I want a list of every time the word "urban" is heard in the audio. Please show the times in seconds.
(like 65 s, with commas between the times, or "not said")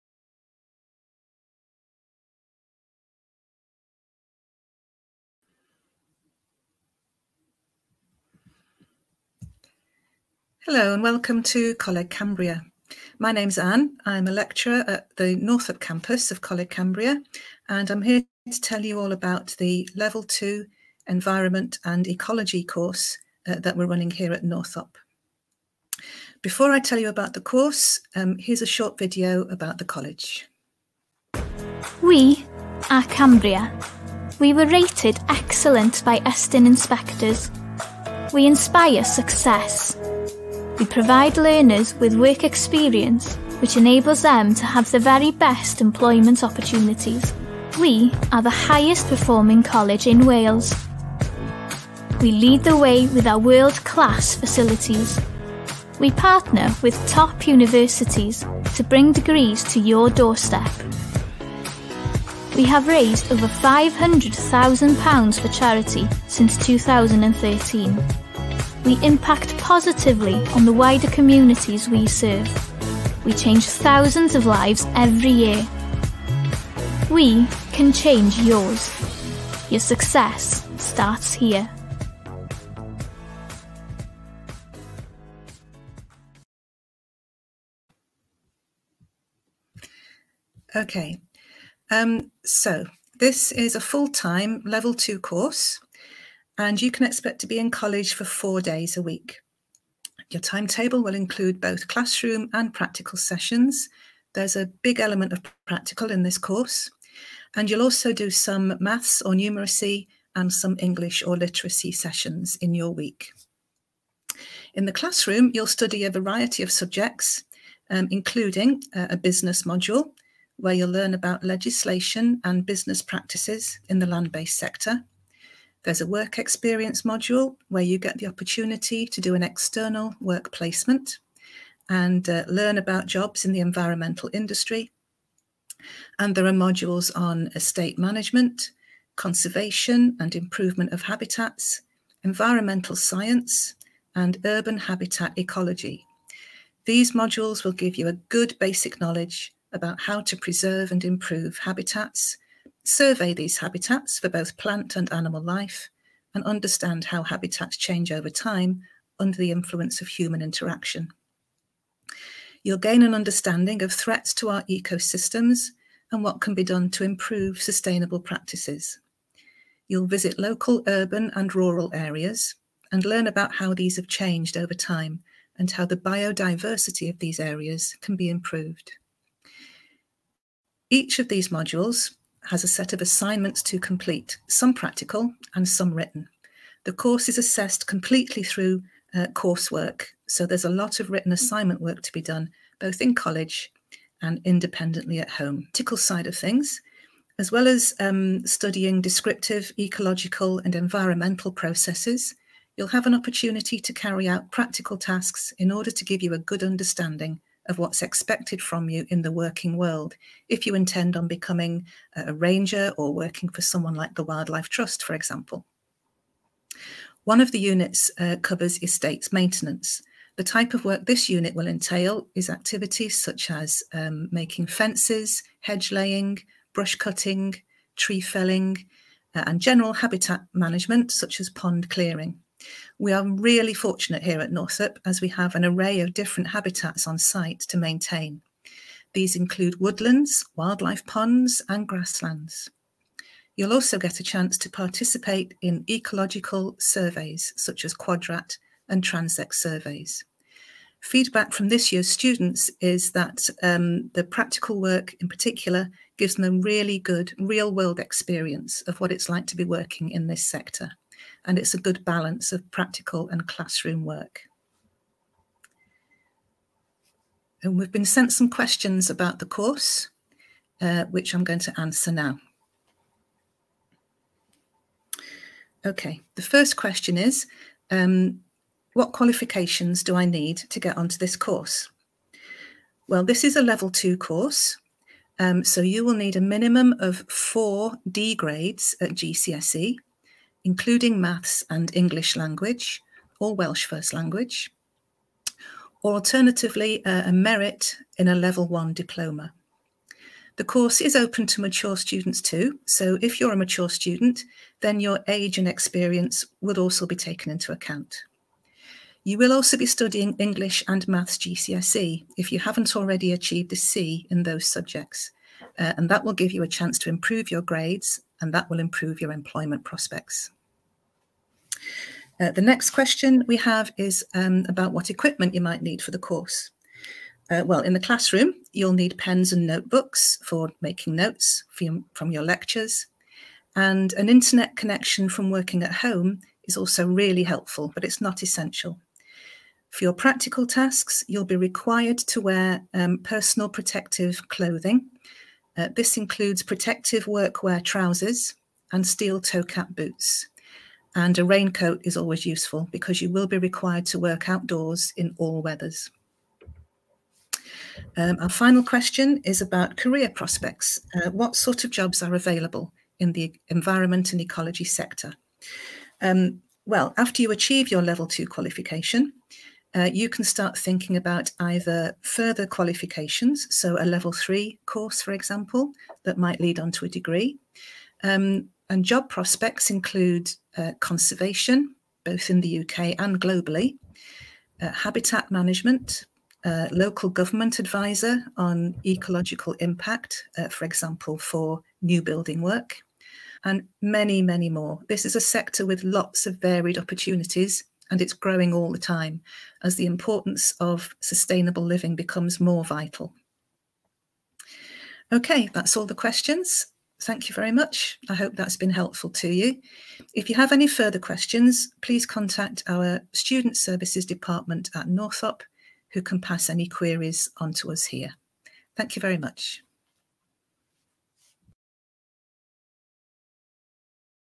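144 s, 170 s.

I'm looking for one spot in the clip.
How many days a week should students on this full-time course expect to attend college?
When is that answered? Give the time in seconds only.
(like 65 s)
98 s.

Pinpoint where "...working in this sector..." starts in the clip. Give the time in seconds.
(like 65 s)
259 s.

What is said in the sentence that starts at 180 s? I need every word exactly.
Each of these modules has a set of assignments to complete, some practical and some written.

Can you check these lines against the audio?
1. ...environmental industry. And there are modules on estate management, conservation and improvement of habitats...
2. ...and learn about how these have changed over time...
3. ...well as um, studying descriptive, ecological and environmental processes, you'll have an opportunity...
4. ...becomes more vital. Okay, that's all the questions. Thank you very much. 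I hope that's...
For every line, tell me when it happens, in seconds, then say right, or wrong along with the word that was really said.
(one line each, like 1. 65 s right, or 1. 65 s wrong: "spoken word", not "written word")
1. 133 s right
2. 172 s right
3. 197 s right
4. 402 s right.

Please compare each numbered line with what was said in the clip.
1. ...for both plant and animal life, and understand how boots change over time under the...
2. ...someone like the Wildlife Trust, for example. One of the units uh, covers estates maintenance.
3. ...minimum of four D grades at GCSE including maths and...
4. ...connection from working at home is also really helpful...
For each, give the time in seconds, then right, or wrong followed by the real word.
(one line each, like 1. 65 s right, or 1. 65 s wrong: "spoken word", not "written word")
1. 154 s wrong: "habitats", not "boots"
2. 213 s right
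3. 286 s right
4. 334 s right.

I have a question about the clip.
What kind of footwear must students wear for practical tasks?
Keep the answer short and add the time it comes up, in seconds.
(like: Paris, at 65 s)
Steel toe cap boots, at 349 s.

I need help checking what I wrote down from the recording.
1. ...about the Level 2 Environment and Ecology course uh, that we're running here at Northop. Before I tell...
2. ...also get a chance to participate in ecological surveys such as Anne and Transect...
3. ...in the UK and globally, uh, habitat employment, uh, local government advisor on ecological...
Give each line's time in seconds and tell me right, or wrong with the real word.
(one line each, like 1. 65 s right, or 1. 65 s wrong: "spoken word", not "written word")
1. 19 s right
2. 243 s wrong: "Quadrat", not "Anne"
3. 382 s wrong: "management", not "employment".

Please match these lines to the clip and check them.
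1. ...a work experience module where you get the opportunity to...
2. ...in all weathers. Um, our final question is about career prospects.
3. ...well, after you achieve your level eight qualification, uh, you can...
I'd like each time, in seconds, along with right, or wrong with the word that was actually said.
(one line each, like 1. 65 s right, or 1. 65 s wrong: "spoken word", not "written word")
1. 126 s right
2. 355 s right
3. 366 s wrong: "two", not "eight".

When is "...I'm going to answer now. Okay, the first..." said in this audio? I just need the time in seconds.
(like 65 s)
271 s.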